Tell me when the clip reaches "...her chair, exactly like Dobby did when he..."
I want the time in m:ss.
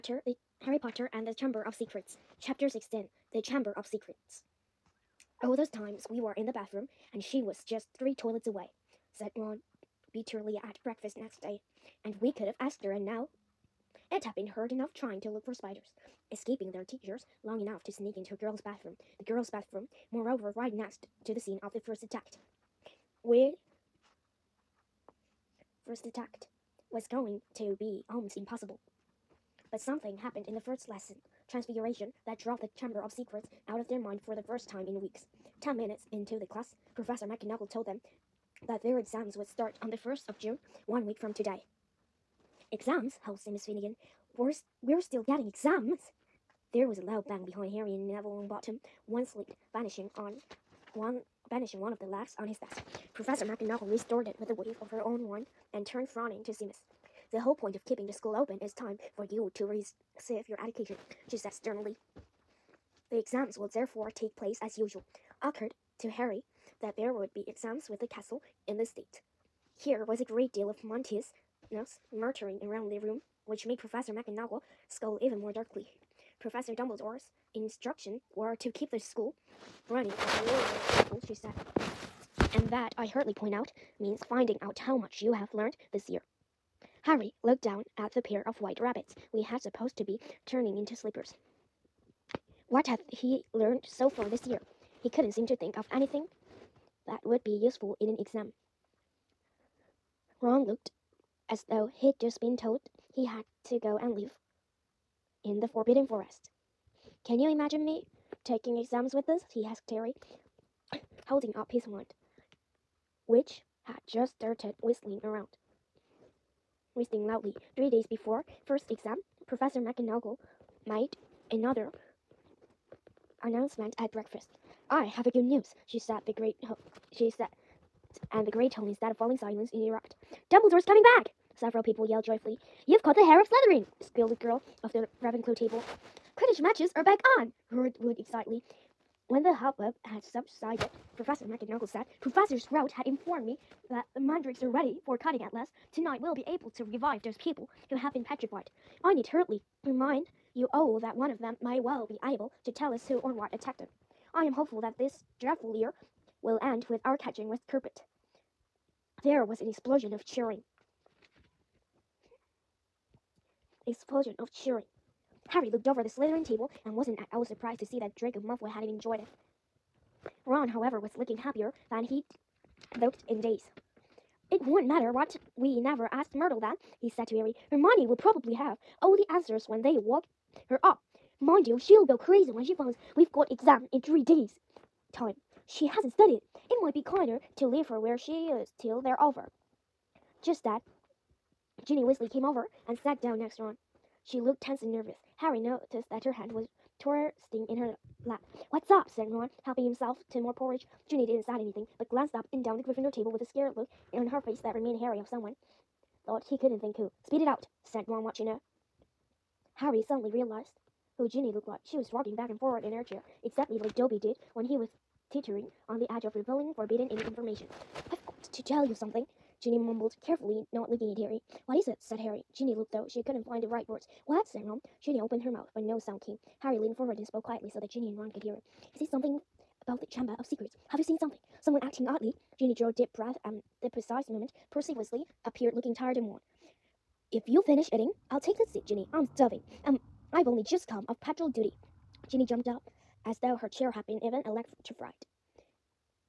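3:32.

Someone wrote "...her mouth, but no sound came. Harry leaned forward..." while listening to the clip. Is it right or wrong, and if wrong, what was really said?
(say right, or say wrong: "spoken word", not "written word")
right.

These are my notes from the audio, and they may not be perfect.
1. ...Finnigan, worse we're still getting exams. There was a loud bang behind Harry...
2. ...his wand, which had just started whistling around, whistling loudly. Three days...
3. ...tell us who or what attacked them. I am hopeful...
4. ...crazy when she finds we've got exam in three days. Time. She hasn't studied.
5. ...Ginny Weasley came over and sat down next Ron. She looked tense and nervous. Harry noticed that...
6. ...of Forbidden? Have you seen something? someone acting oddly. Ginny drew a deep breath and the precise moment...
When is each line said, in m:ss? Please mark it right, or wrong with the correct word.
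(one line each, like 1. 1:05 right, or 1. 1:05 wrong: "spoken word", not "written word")
1. 0:43 right
2. 1:51 right
3. 2:32 right
4. 3:02 right
5. 3:11 right
6. 3:50 wrong: "Secrets", not "Forbidden".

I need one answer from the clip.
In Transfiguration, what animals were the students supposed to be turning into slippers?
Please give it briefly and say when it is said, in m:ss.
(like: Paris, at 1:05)
white rabbits, at 1:28.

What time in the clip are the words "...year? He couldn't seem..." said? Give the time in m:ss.
1:34.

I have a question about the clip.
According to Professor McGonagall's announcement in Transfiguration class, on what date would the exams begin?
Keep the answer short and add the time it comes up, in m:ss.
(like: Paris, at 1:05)
1st of June, at 0:40.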